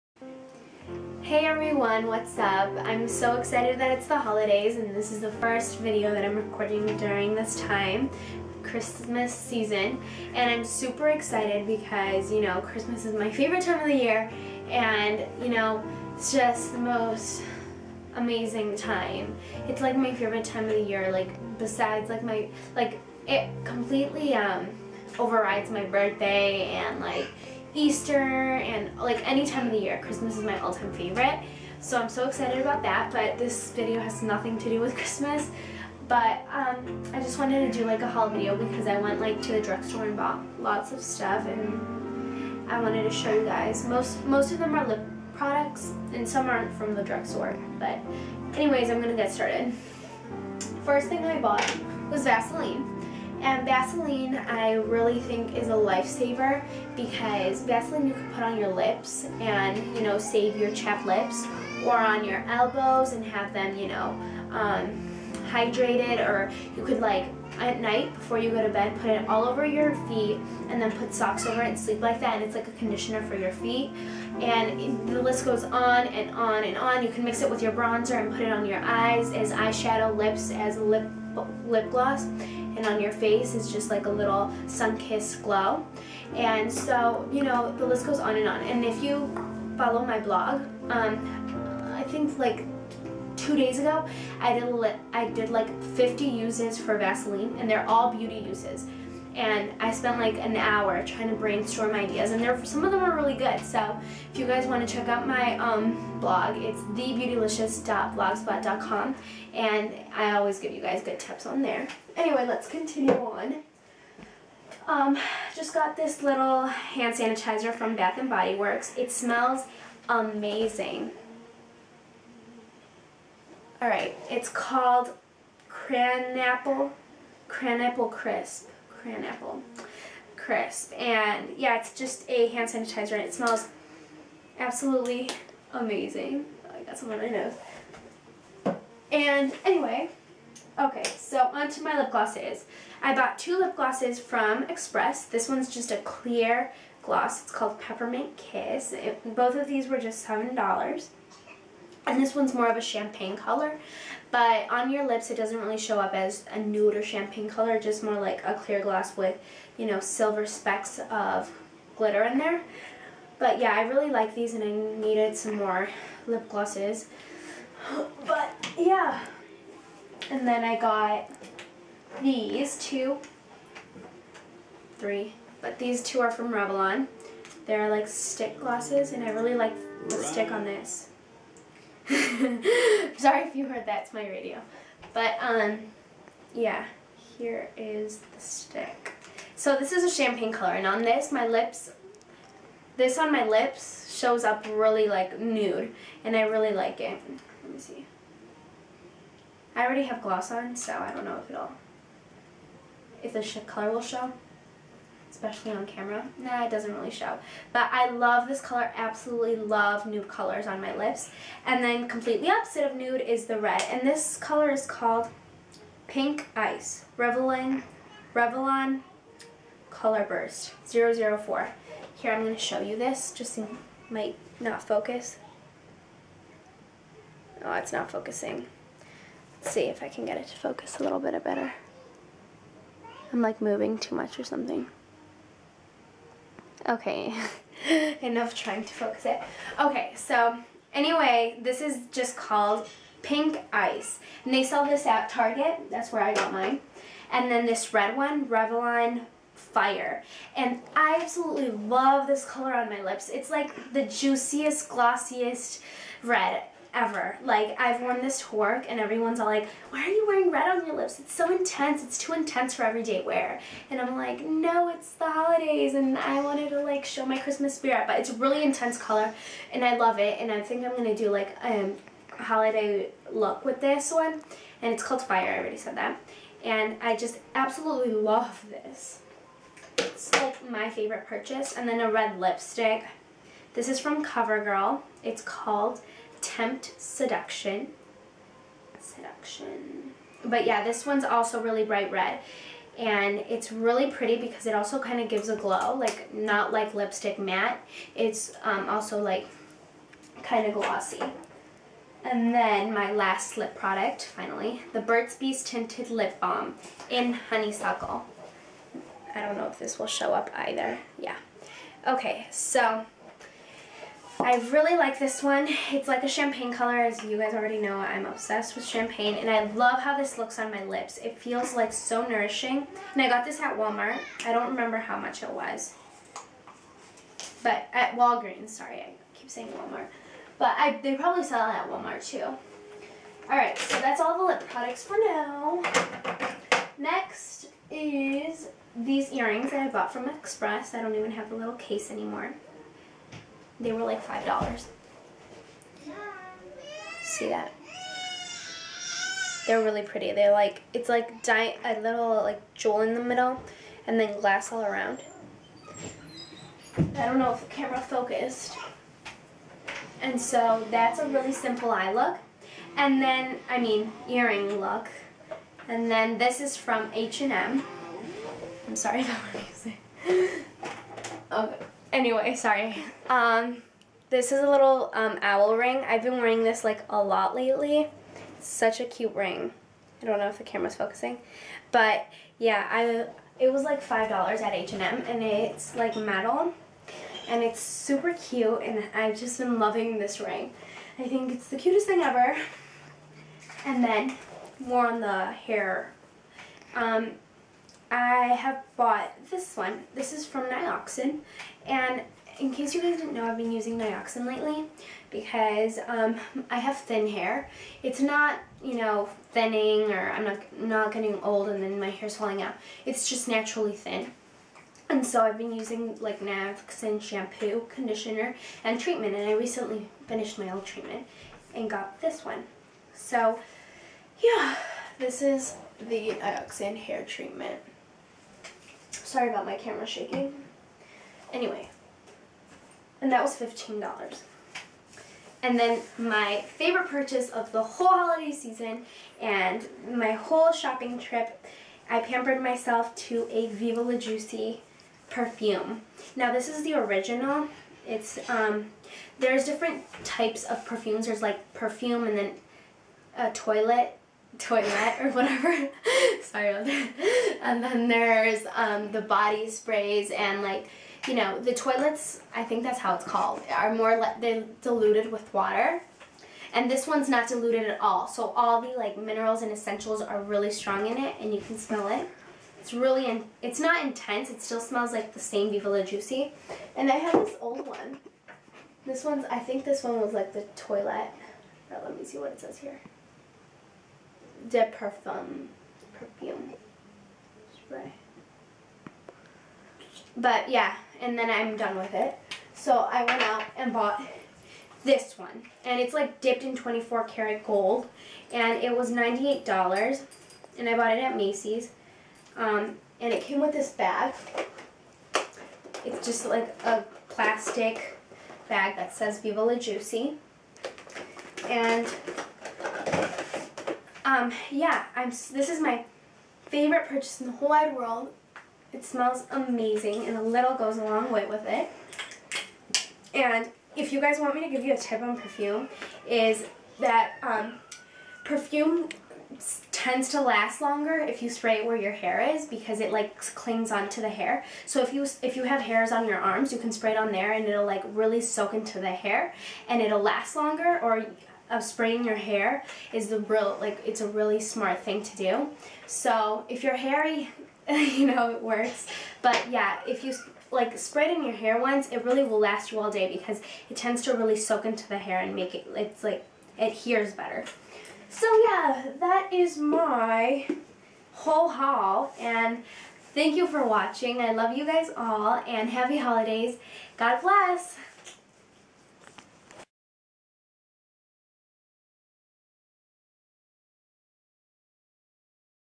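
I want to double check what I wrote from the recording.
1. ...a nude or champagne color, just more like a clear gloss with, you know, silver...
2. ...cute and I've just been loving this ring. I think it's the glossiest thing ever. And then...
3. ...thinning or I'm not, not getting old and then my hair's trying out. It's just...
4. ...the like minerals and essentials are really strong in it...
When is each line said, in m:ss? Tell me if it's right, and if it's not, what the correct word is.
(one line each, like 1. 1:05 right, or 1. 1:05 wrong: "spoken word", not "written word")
1. 2:36 right
2. 6:28 wrong: "cutest", not "glossiest"
3. 6:49 wrong: "falling", not "trying"
4. 7:48 right.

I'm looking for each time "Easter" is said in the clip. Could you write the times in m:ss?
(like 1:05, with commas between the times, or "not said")
0:27.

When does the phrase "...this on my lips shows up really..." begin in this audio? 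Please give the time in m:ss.
3:12.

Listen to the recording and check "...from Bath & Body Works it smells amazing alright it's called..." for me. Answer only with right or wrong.
right.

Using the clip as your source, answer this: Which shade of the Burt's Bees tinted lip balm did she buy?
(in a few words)
Honeysuckle.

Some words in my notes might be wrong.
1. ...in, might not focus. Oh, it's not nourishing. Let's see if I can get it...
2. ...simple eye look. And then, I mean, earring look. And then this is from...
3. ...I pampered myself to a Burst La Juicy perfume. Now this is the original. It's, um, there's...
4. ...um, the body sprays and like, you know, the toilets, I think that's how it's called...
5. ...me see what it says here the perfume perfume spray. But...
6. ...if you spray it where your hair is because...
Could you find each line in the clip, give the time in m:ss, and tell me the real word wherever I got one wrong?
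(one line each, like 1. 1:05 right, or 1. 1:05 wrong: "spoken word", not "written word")
1. 3:43 wrong: "focusing", not "nourishing"
2. 6:01 right
3. 7:22 wrong: "Viva", not "Burst"
4. 7:38 right
5. 8:02 right
6. 8:51 right.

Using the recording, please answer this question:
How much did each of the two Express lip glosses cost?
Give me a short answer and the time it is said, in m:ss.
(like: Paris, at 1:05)
$7, at 2:30.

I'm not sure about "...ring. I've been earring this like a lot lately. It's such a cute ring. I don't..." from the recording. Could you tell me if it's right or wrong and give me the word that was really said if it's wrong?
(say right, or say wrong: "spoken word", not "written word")
wrong: "wearing", not "earring".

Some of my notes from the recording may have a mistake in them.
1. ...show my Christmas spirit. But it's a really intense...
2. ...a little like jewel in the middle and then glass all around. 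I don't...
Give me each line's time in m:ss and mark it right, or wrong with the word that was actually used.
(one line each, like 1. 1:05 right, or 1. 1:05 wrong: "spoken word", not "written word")
1. 4:27 right
2. 5:51 right.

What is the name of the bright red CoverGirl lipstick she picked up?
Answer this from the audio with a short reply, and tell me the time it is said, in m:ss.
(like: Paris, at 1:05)
Tempt Seduction, at 4:46.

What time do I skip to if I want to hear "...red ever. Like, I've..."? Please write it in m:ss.
4:16.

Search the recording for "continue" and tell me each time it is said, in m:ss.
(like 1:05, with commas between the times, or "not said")
1:52.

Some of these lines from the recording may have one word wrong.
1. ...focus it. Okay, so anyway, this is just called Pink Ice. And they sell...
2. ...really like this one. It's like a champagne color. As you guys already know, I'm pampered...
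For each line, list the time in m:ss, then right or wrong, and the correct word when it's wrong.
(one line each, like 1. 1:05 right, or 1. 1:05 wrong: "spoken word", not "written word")
1. 3:58 right
2. 5:14 wrong: "obsessed", not "pampered".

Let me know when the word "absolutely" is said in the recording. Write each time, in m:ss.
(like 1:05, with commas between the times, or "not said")
2:14, 3:28, 4:11, 4:37.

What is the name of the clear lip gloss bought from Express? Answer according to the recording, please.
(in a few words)
Peppermint Kiss.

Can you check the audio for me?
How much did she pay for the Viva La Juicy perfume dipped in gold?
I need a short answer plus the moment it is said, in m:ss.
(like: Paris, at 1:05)
$98, at 8:19.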